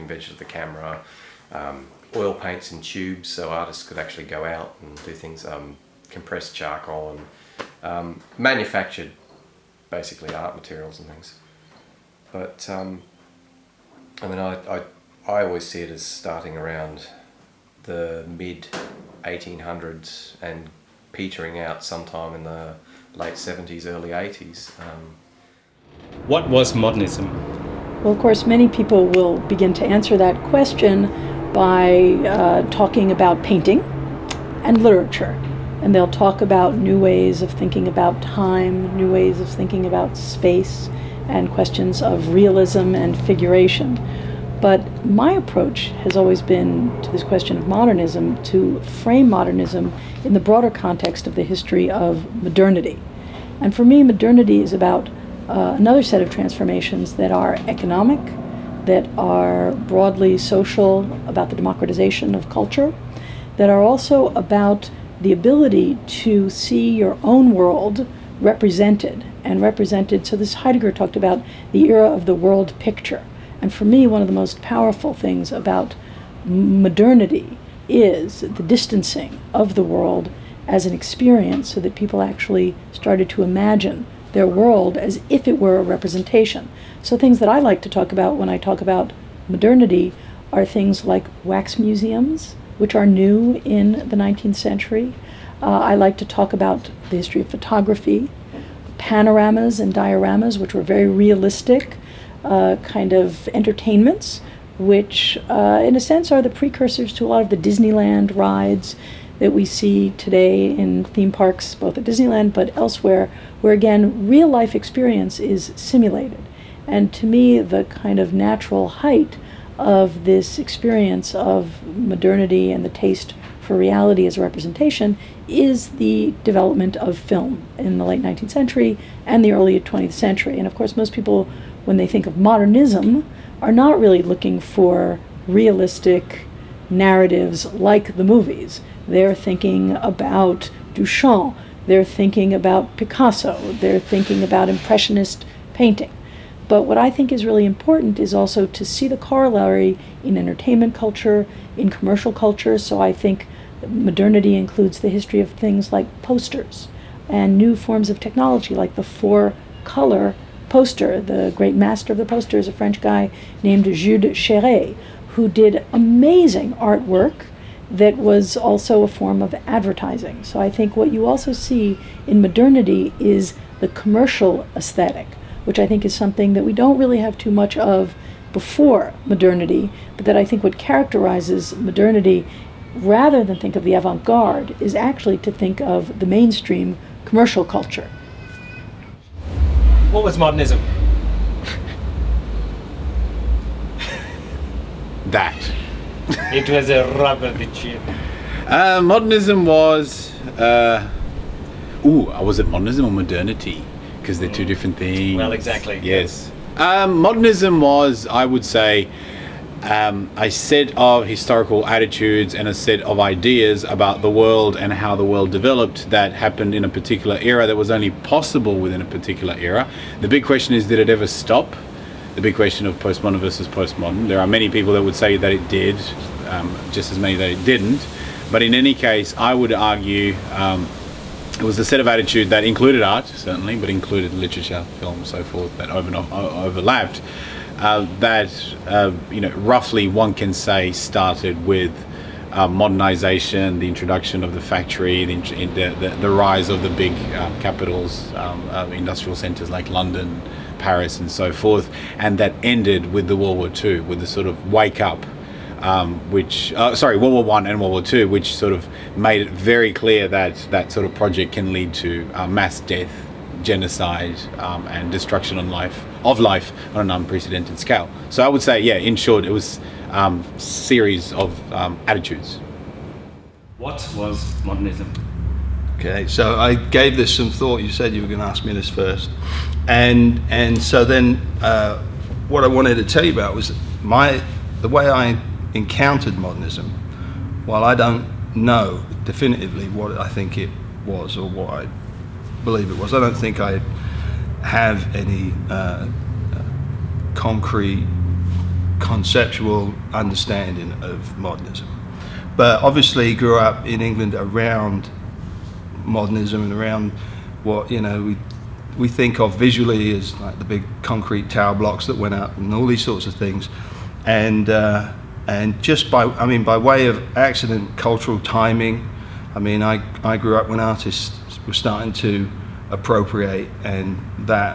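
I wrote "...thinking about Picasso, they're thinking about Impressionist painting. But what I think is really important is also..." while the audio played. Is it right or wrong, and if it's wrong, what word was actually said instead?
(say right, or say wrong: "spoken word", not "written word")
right.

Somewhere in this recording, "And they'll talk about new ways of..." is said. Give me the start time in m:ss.
0:35.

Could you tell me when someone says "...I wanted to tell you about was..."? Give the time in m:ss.
4:42.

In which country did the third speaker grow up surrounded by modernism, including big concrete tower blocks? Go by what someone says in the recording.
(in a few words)
England.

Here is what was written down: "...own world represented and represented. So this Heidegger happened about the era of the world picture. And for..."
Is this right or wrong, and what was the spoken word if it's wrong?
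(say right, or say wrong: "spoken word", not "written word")
wrong: "talked", not "happened".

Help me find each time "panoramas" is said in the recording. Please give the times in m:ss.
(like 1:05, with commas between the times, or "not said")
1:38.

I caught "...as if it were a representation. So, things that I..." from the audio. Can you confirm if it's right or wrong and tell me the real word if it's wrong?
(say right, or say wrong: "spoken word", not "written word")
right.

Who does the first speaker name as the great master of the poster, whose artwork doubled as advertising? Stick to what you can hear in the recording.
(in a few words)
Jules Chéret.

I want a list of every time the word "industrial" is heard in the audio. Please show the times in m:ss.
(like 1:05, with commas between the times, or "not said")
4:08.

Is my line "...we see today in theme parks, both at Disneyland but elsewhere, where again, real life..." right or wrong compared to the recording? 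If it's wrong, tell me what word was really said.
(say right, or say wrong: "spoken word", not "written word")
right.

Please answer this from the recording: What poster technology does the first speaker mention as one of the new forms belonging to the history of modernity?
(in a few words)
four color poster.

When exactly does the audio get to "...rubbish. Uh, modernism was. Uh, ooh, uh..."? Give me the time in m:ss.
3:17.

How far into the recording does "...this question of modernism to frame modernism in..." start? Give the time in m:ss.
0:47.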